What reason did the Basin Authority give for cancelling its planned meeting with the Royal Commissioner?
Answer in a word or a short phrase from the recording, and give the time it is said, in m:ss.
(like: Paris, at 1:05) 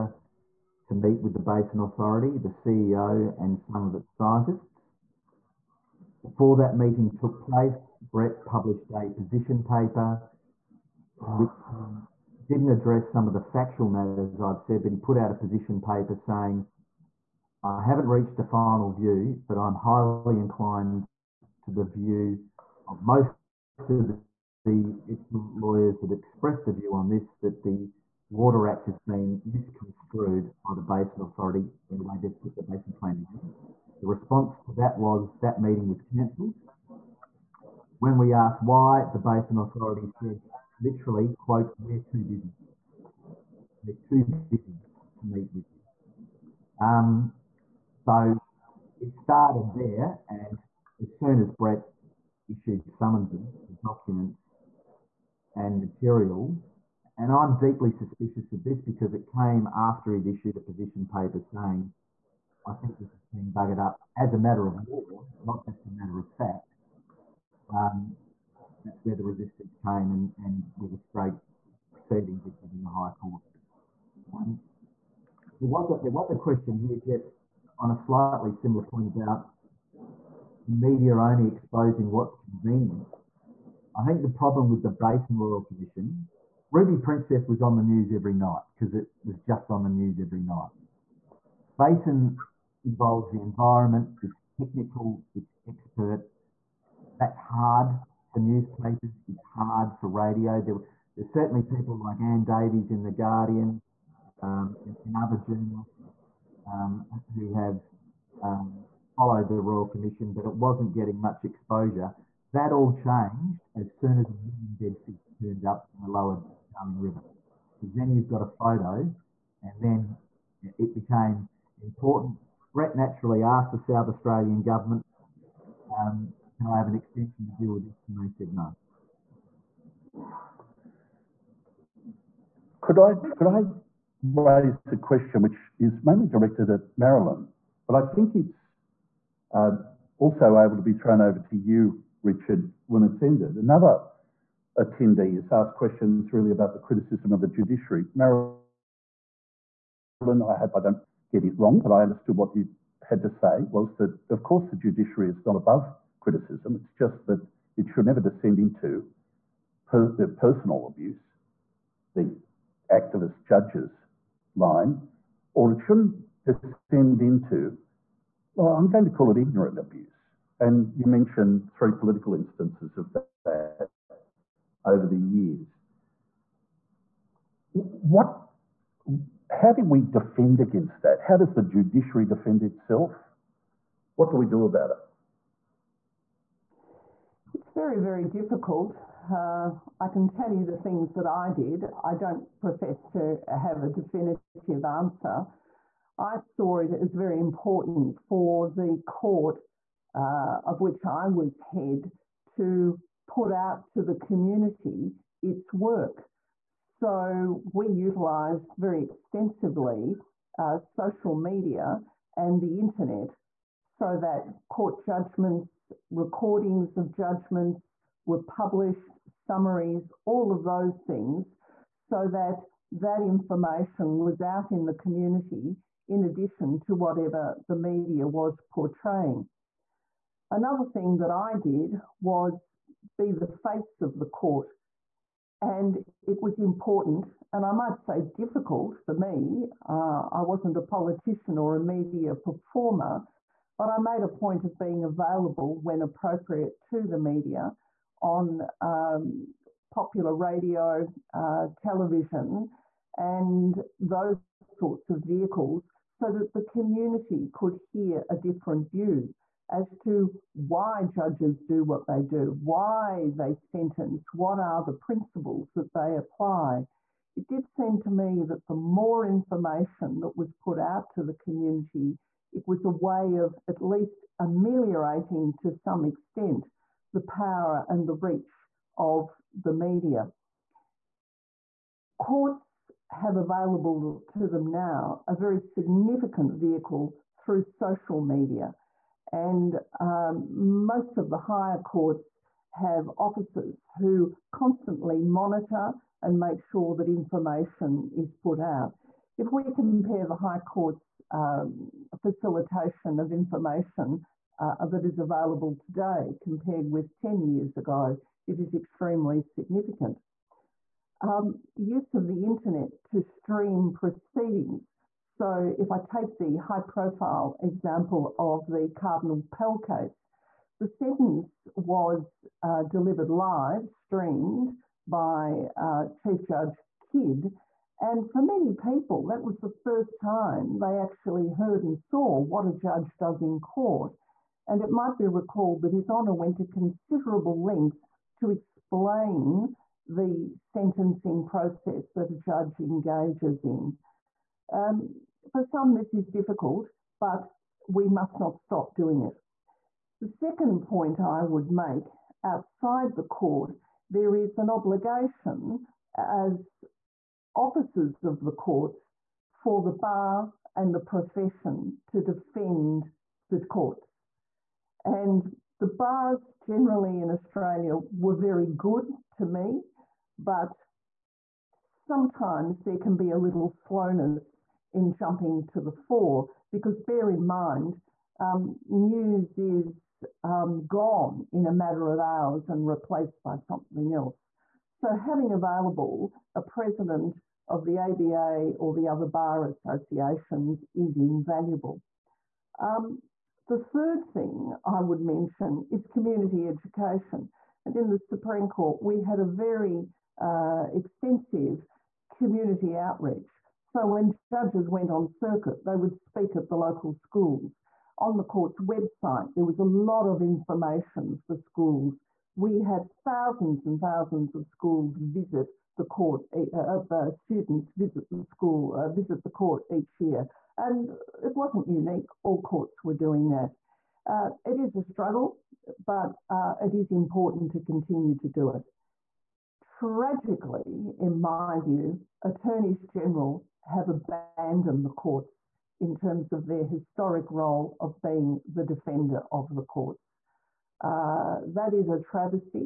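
We're too busy, at 0:41.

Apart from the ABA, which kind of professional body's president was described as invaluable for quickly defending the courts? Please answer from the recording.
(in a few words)
bar associations.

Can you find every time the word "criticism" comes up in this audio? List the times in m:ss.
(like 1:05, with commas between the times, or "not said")
2:26, 2:36.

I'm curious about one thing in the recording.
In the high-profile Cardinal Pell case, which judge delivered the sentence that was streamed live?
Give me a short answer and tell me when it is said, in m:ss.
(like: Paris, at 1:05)
Chief Judge Kidd, at 5:26.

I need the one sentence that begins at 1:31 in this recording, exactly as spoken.
Basin involves the environment, it's technical, it's expert.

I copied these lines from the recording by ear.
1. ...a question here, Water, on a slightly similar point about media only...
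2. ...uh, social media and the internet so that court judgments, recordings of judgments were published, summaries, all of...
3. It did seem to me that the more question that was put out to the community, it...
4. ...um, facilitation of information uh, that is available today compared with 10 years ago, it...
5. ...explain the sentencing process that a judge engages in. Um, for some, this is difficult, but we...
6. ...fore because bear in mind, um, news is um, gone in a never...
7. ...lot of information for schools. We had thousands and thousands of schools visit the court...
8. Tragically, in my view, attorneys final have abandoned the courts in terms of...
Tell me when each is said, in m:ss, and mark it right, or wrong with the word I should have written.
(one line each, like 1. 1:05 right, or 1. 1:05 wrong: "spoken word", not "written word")
1. 1:16 wrong: "Geoff", not "Water"
2. 3:30 right
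3. 4:27 wrong: "information", not "question"
4. 5:01 right
5. 5:38 right
6. 6:15 wrong: "matter", not "never"
7. 6:49 right
8. 7:09 wrong: "general", not "final".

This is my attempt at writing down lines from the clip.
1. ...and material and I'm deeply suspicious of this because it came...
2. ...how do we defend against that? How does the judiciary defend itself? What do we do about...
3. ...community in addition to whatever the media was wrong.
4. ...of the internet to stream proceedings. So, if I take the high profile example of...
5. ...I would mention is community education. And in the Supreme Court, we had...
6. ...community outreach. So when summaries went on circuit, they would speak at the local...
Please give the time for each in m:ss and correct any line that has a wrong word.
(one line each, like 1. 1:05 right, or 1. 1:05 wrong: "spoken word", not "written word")
1. 0:55 right
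2. 2:59 right
3. 3:44 wrong: "portraying", not "wrong"
4. 5:12 right
5. 6:34 right
6. 6:42 wrong: "judges", not "summaries".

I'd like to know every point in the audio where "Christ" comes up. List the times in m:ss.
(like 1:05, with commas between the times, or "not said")
not said.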